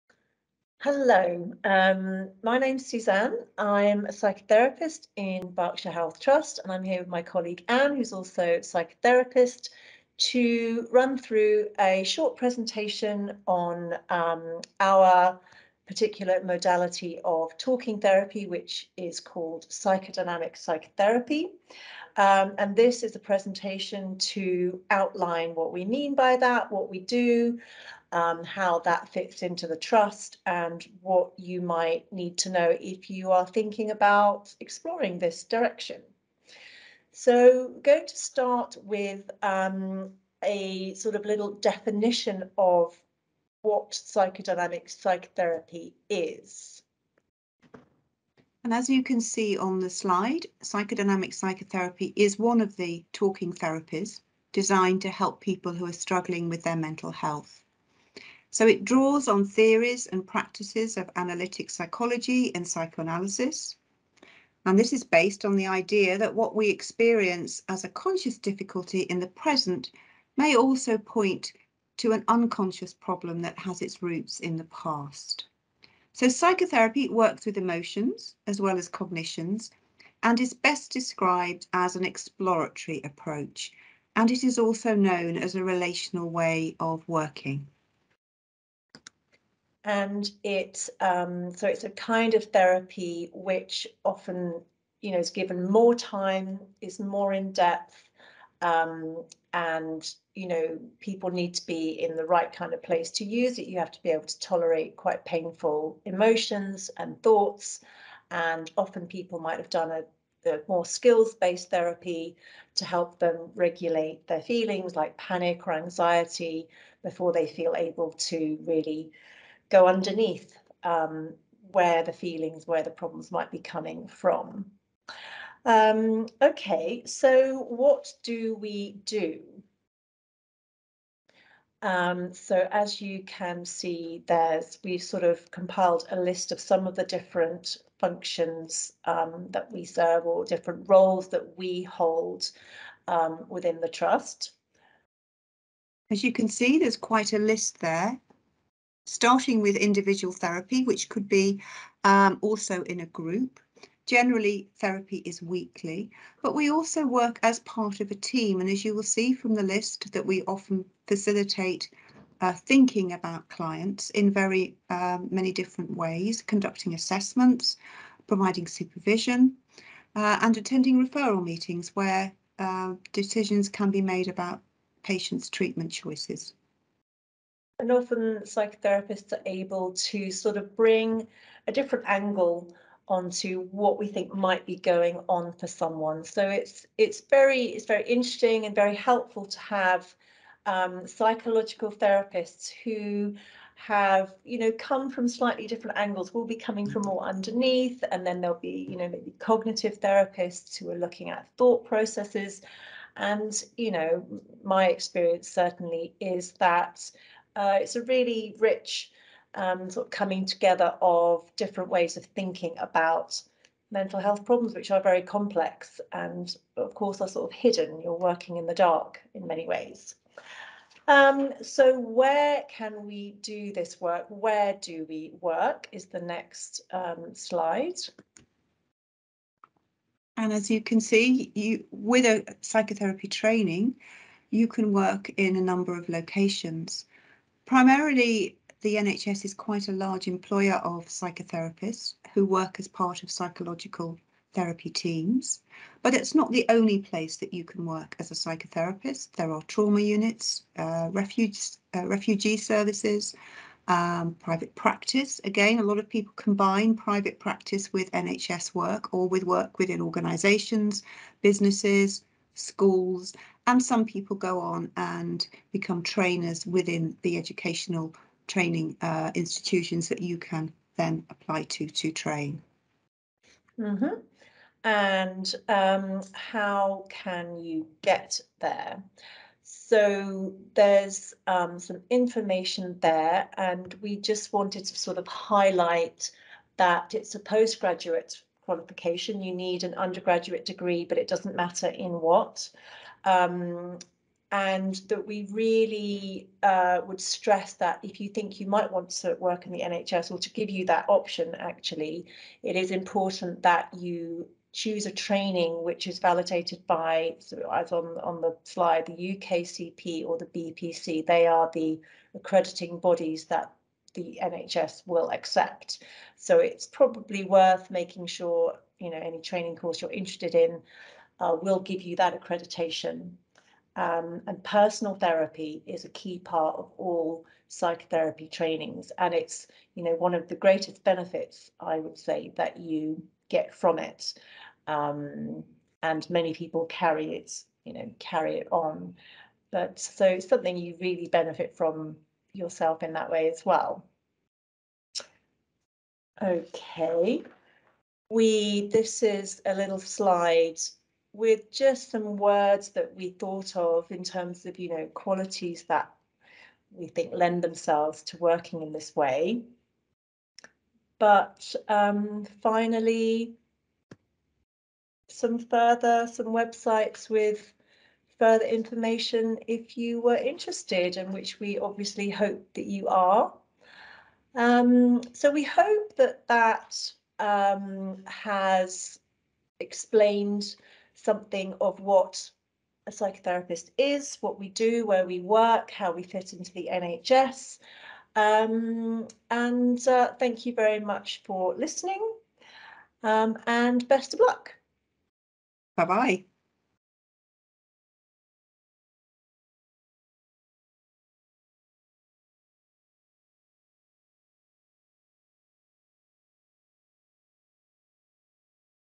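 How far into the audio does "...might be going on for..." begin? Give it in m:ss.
3:04.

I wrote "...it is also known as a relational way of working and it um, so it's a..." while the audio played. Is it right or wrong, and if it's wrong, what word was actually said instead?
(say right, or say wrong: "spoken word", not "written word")
right.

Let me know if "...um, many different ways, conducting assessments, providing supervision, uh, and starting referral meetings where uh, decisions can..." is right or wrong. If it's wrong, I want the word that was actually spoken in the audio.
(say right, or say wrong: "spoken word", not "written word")
wrong: "attending", not "starting".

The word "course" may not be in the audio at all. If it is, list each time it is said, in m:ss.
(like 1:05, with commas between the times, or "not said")
3:36, 5:19.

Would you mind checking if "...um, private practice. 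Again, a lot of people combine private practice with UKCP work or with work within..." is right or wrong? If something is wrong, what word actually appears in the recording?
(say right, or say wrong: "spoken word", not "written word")
wrong: "NHS", not "UKCP".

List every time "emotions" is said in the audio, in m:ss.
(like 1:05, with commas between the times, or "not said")
1:17, 1:46.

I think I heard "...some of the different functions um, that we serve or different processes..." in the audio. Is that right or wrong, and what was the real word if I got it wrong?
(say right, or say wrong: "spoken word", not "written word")
wrong: "roles", not "processes".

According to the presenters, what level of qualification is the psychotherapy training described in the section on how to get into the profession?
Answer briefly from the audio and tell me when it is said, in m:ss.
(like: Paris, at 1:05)
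Postgraduate, at 4:47.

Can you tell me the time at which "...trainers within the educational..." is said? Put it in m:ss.
4:26.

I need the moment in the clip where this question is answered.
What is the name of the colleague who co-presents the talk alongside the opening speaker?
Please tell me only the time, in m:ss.
0:07.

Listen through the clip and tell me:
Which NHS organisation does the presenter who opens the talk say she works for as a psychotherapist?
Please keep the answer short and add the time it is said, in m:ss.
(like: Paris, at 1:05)
Berkshire Health Trust, at 0:05.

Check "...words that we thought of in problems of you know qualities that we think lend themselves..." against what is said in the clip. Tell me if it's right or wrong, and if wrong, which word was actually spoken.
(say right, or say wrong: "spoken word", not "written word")
wrong: "terms", not "problems".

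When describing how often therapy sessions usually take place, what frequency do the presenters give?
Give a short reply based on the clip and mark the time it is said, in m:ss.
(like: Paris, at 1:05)
Weekly, at 2:35.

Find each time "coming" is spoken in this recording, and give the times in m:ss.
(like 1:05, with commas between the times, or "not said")
2:03, 3:16, 3:30.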